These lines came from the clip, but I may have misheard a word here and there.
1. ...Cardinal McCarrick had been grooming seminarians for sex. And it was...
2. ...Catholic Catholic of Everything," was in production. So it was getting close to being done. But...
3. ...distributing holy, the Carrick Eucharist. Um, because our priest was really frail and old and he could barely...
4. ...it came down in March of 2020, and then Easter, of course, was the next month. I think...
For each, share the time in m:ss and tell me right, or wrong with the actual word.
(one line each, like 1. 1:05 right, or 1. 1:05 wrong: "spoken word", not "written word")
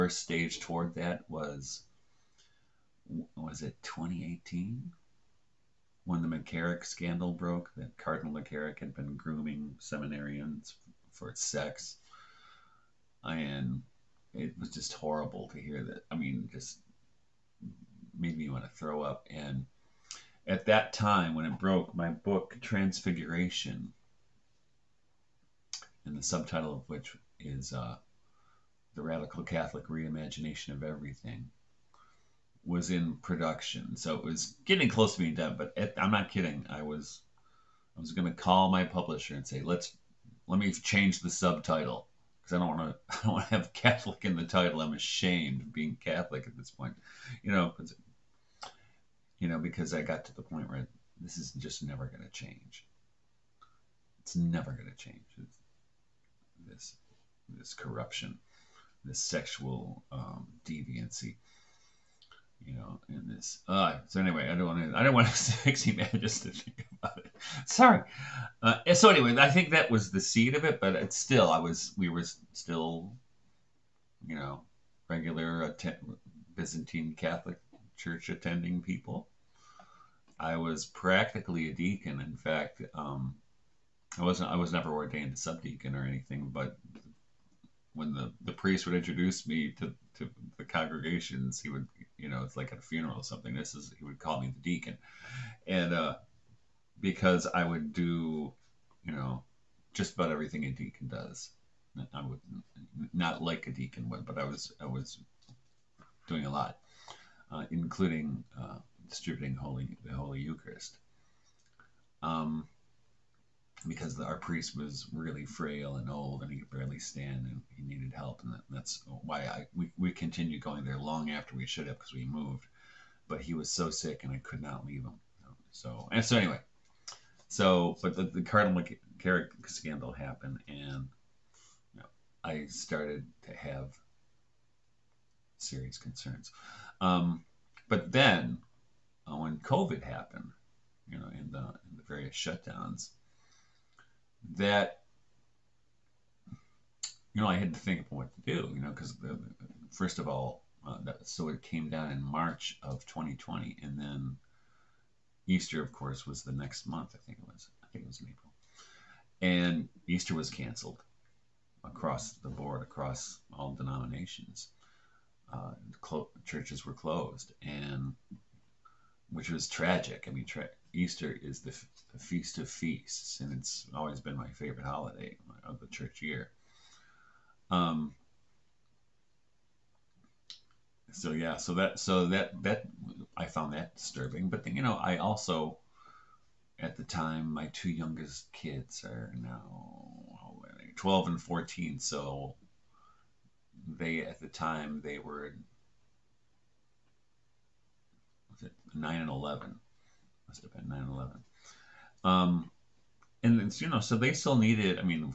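1. 0:07 right
2. 0:29 wrong: "Reimagination", not "Catholic"
3. 1:49 wrong: "Holy", not "Carrick"
4. 2:31 right.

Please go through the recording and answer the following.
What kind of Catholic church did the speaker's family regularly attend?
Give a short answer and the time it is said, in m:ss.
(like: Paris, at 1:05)
Byzantine Catholic, at 1:16.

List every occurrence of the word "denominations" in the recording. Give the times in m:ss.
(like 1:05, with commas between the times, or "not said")
2:43.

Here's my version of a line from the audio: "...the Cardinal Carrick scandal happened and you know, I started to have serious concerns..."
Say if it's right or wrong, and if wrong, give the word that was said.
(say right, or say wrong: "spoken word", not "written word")
right.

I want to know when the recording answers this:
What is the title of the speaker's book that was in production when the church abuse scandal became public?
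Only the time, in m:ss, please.
0:22.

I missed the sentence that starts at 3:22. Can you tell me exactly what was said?
Um, and you know, so they still needed.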